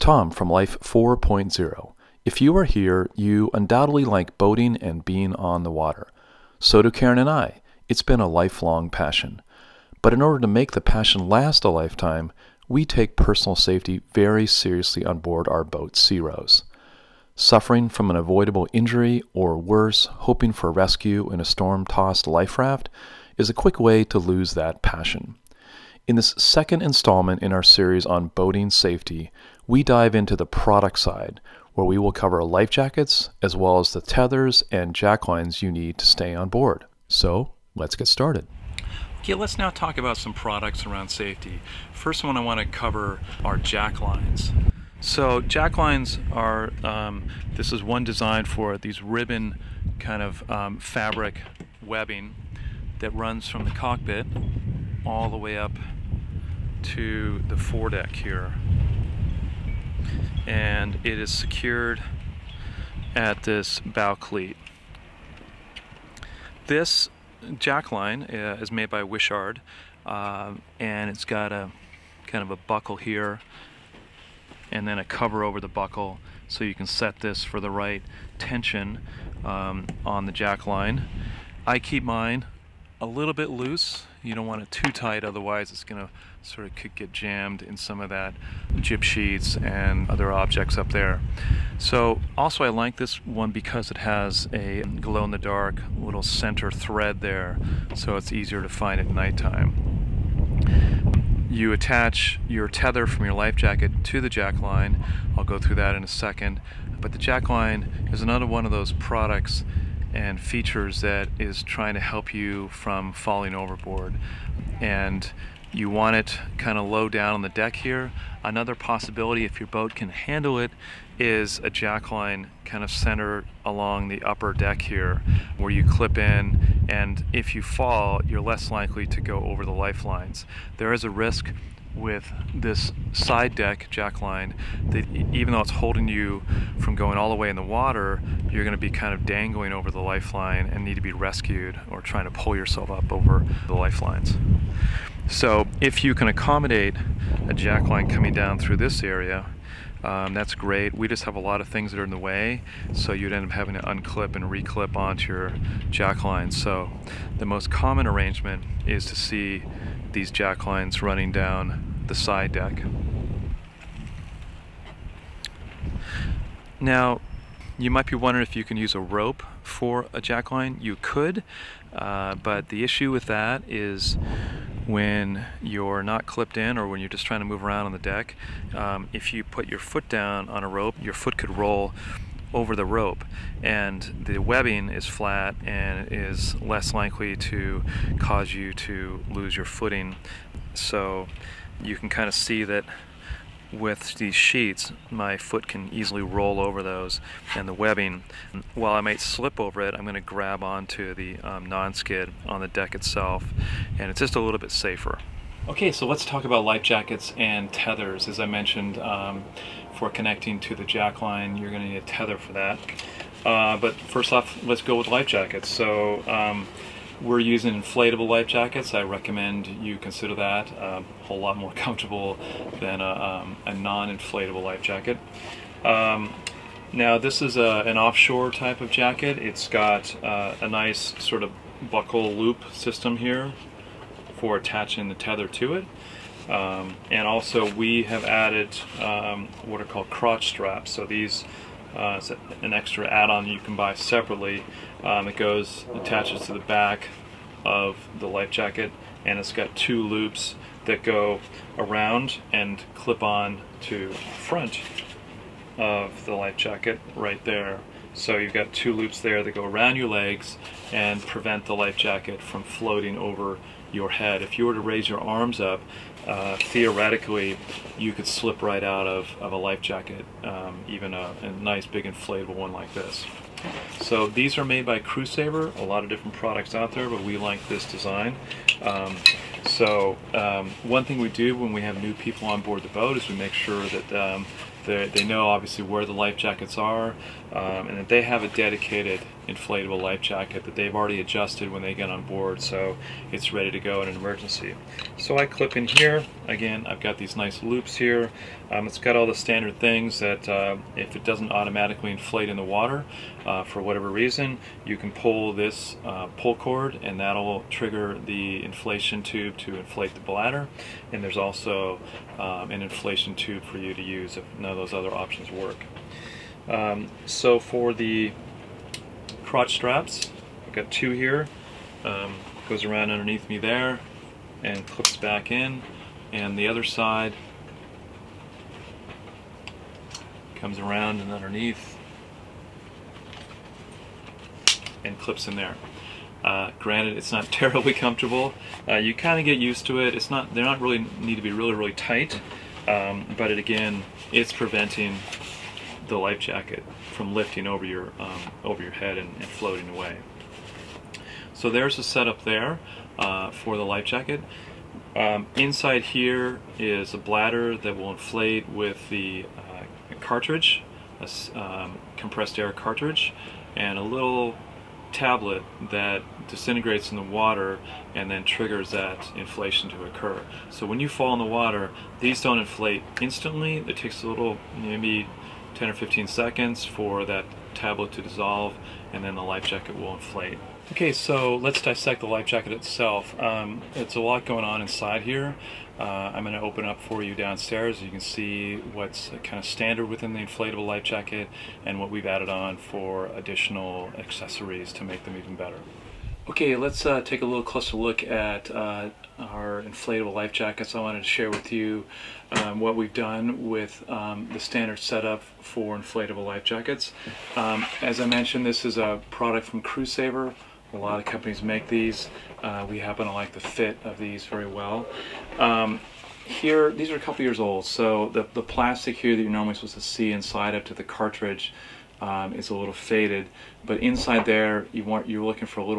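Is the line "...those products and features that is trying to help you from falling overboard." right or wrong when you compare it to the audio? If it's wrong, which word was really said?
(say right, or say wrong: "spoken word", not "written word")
right.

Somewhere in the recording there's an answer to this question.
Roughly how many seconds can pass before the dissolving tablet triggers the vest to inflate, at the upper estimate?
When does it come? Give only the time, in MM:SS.
06:15.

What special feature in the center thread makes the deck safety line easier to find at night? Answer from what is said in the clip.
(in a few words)
glow-in-the-dark.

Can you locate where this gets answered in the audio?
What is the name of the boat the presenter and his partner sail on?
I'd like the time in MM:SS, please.
00:15.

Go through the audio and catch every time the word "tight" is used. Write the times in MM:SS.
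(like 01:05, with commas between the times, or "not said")
01:24, 05:41.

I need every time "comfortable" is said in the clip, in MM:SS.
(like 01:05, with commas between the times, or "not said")
03:41, 05:37.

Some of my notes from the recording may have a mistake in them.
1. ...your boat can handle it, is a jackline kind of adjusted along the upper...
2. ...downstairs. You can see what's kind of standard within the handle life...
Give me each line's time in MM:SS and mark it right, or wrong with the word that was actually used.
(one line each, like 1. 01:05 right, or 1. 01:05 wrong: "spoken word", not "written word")
1. 01:59 wrong: "centered", not "adjusted"
2. 06:27 wrong: "inflatable", not "handle".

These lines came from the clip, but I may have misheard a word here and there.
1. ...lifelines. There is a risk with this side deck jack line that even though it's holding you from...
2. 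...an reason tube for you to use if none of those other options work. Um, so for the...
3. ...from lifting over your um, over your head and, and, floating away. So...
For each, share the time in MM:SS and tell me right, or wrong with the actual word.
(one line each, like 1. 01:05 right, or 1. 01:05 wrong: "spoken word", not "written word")
1. 02:09 right
2. 05:12 wrong: "inflation", not "reason"
3. 05:47 right.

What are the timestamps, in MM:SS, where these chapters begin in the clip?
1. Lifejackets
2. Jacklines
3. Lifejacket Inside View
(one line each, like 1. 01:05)
1. 03:24
2. 00:37
3. 06:35.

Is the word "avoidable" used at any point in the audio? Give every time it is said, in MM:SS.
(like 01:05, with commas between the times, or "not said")
00:18.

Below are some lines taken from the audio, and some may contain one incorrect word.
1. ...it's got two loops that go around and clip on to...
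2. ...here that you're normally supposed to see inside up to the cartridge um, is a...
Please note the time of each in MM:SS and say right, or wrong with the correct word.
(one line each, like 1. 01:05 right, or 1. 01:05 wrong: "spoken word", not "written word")
1. 04:09 right
2. 06:59 right.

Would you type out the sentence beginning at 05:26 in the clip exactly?
And the other side comes around and underneath and clips in there.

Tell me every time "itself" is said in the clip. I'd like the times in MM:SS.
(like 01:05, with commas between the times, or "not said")
03:22, 06:22.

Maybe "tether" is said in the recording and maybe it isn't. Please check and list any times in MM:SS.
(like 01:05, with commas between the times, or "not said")
00:33, 01:42, 03:27, 03:32, 03:55.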